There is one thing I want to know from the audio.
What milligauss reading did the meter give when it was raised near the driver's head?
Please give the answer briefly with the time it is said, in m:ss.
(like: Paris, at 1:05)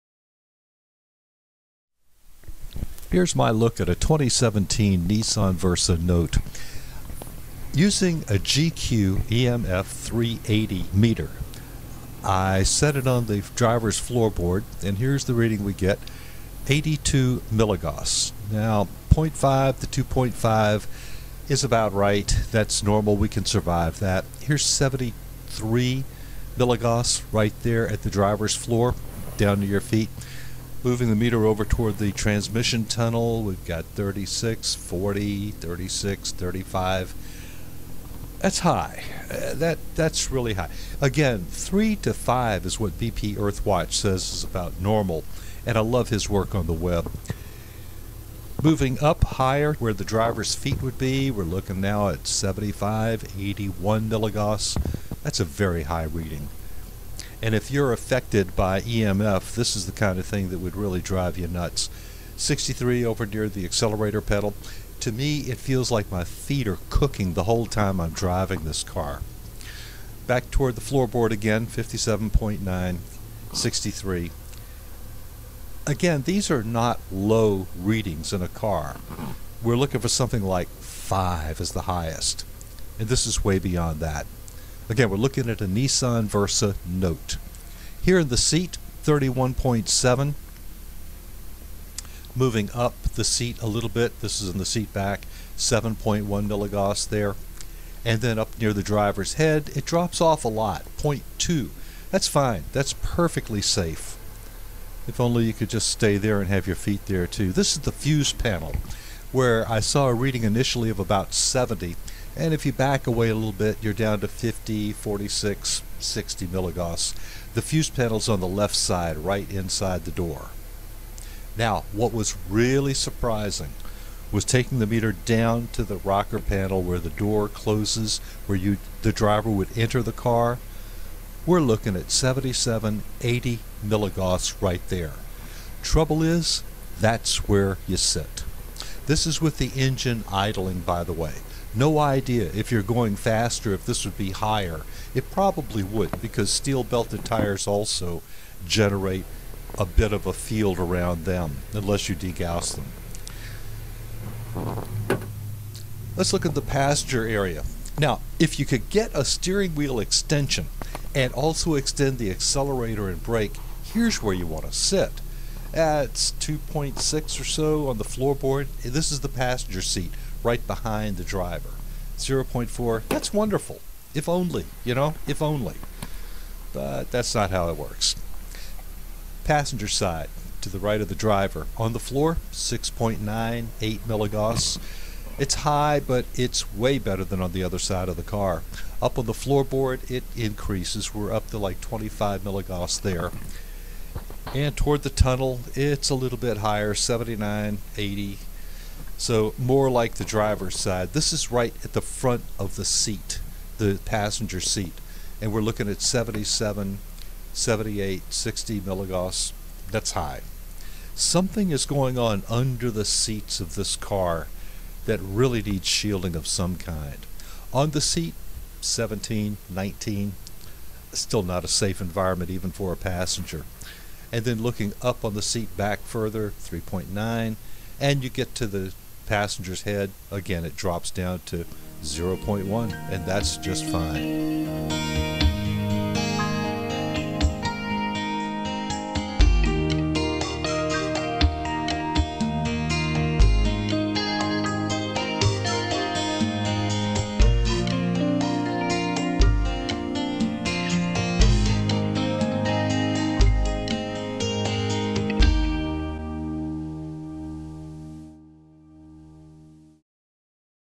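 0.2, at 1:40.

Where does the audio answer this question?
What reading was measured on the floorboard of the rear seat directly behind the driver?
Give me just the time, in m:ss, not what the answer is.
2:46.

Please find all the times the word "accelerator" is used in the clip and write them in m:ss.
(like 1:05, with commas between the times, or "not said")
1:03, 2:42.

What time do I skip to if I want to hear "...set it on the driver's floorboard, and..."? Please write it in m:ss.
0:12.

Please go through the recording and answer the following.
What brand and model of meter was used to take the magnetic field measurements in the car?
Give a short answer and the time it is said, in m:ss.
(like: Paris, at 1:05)
GQ EMF 380, at 0:08.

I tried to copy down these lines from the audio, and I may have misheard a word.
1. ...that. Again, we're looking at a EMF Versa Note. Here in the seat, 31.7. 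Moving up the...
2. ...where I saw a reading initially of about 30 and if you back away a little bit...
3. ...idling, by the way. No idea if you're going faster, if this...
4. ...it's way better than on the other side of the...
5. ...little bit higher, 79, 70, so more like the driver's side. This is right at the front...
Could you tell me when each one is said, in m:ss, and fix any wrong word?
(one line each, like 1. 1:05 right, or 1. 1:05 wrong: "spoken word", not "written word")
1. 1:23 wrong: "Nissan", not "EMF"
2. 1:49 wrong: "70", not "30"
3. 2:20 right
4. 3:06 right
5. 3:16 wrong: "80", not "70".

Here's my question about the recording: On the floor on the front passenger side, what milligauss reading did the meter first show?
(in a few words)
6.98.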